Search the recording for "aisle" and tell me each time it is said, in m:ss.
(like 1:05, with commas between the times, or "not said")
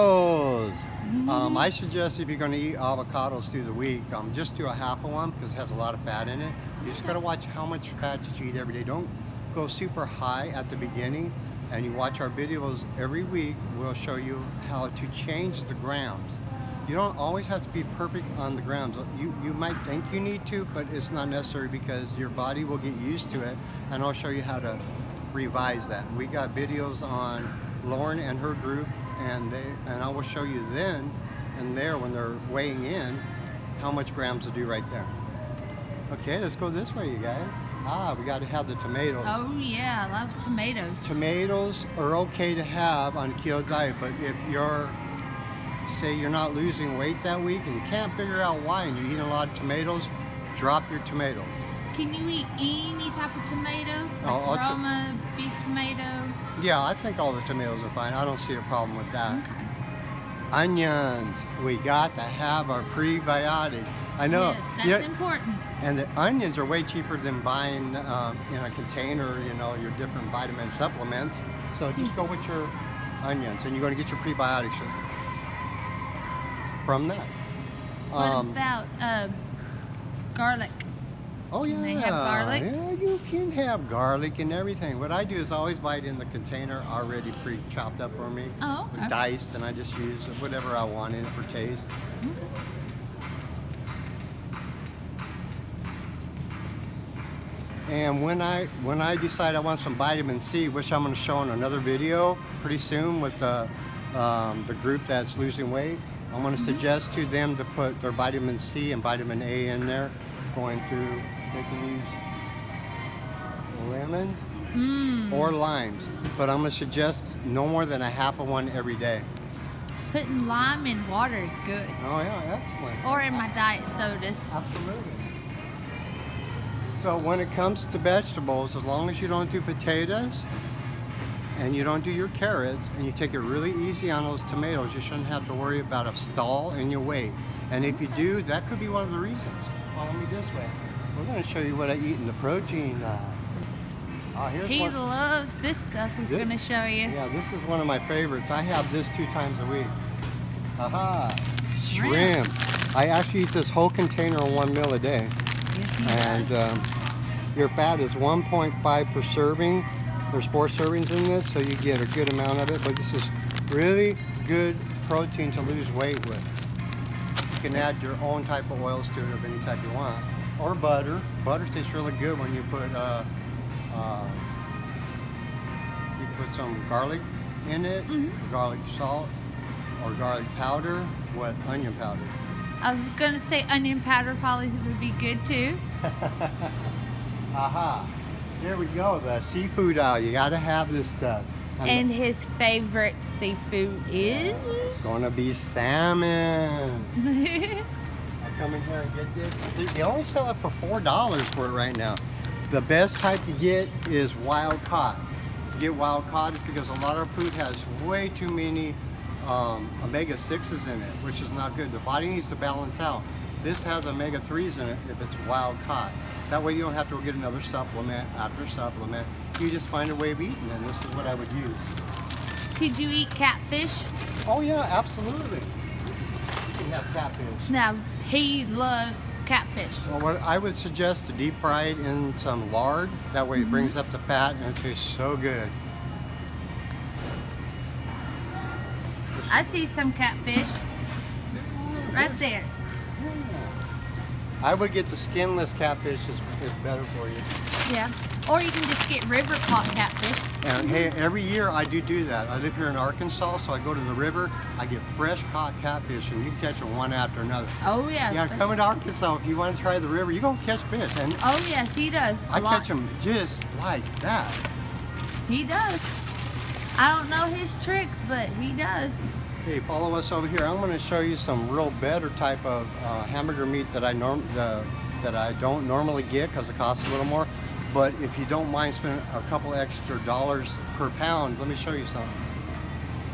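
3:09.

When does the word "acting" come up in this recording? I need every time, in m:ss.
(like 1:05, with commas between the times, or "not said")
not said.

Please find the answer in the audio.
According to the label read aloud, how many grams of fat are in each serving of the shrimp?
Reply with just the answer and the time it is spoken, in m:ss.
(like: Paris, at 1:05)
1.5, at 2:38.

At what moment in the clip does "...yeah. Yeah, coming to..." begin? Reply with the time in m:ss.
4:18.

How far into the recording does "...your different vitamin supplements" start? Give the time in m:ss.
1:09.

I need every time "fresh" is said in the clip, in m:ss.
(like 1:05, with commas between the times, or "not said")
4:15.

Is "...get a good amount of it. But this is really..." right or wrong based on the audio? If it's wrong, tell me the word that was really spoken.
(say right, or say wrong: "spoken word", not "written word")
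right.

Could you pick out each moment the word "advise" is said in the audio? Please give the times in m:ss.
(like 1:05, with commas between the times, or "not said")
not said.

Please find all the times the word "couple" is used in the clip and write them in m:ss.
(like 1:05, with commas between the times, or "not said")
4:39.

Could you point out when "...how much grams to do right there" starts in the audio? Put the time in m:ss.
0:33.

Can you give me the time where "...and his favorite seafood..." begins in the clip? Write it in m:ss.
3:11.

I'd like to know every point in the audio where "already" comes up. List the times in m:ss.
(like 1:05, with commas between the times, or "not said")
1:26.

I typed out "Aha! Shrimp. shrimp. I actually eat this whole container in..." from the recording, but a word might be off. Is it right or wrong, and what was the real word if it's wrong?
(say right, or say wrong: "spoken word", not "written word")
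right.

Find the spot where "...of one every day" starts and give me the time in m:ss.
1:58.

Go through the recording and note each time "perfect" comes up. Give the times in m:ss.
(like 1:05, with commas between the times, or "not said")
0:17.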